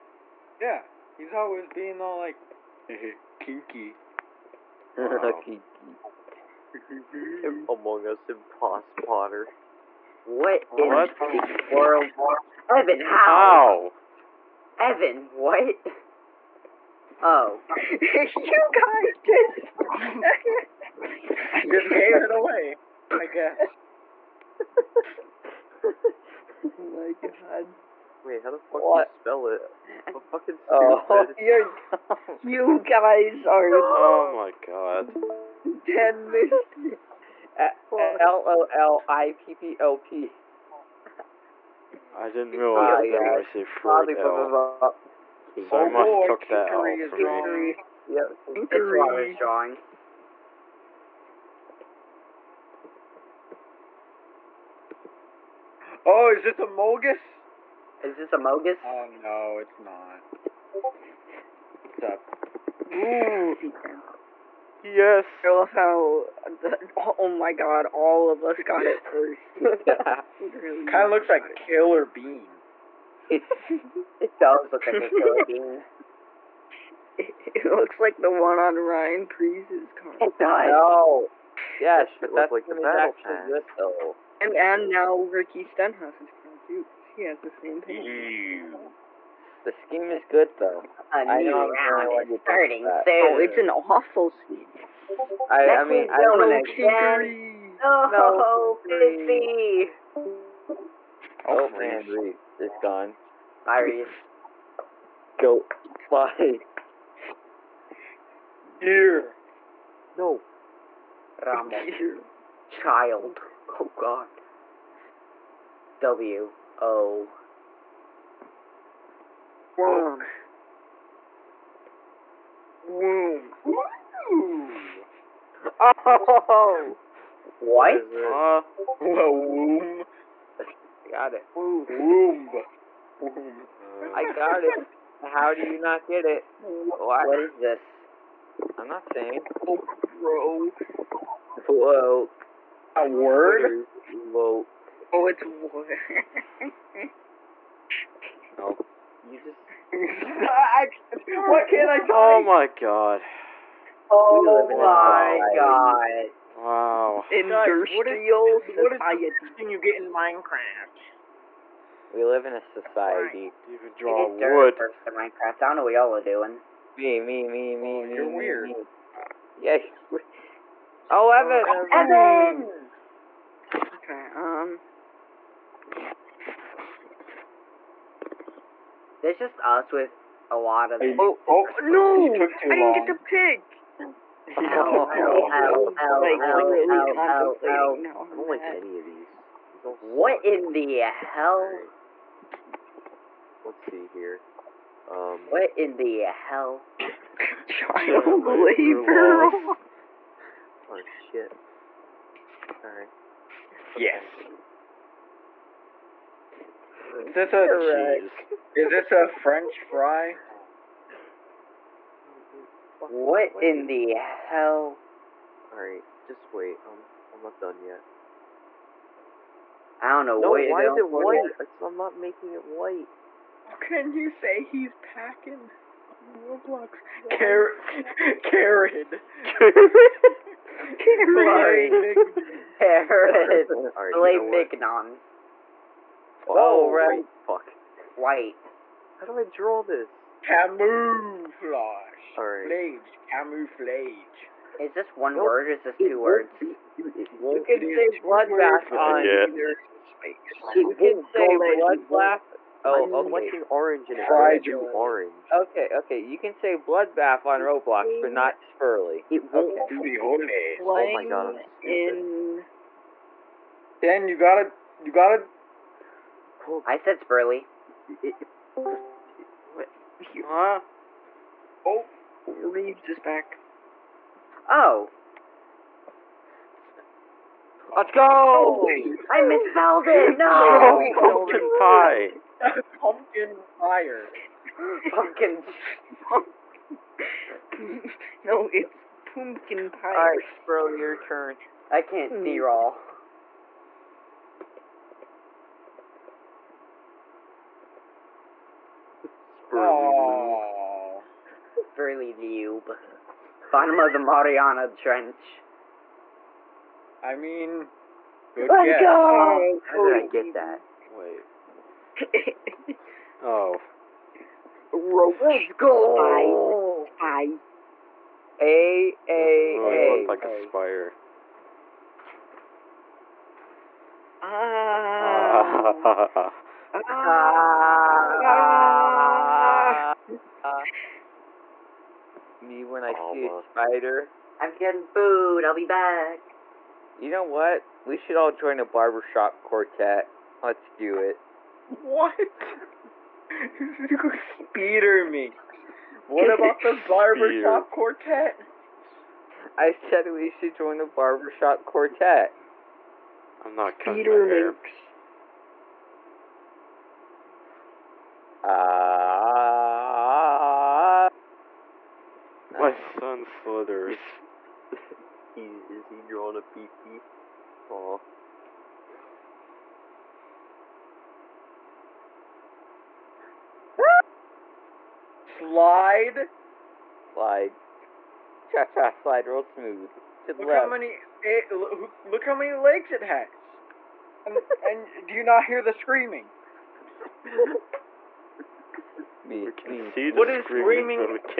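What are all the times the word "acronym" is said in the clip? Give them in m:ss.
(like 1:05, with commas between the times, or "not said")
not said.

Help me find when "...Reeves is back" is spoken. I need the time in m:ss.
4:32.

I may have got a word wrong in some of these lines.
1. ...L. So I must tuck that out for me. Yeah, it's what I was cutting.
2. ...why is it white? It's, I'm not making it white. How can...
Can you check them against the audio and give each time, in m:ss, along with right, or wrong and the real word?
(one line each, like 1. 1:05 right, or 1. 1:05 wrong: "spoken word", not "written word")
1. 0:44 wrong: "drawing", not "cutting"
2. 3:40 right.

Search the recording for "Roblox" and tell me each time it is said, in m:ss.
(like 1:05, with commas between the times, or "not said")
3:46, 4:17.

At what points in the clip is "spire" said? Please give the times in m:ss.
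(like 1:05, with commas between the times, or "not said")
5:20.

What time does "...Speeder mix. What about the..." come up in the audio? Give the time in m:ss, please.
5:44.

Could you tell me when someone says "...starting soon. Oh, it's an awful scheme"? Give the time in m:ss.
1:32.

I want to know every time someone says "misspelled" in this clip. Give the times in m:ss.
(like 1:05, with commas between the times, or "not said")
4:39.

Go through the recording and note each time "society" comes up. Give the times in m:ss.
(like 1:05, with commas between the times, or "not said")
2:38, 2:42.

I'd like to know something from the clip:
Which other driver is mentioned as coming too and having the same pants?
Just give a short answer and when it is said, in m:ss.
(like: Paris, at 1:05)
Ricky Stenhouse, at 1:25.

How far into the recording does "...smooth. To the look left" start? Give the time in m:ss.
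6:19.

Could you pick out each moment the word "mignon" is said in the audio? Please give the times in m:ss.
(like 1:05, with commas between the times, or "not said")
3:54.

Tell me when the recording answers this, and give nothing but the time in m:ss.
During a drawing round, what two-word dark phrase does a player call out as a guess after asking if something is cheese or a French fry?
3:17.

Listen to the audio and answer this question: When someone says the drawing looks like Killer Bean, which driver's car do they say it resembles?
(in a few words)
Ryan Preece.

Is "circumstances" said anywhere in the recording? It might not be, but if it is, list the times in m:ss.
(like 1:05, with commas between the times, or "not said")
not said.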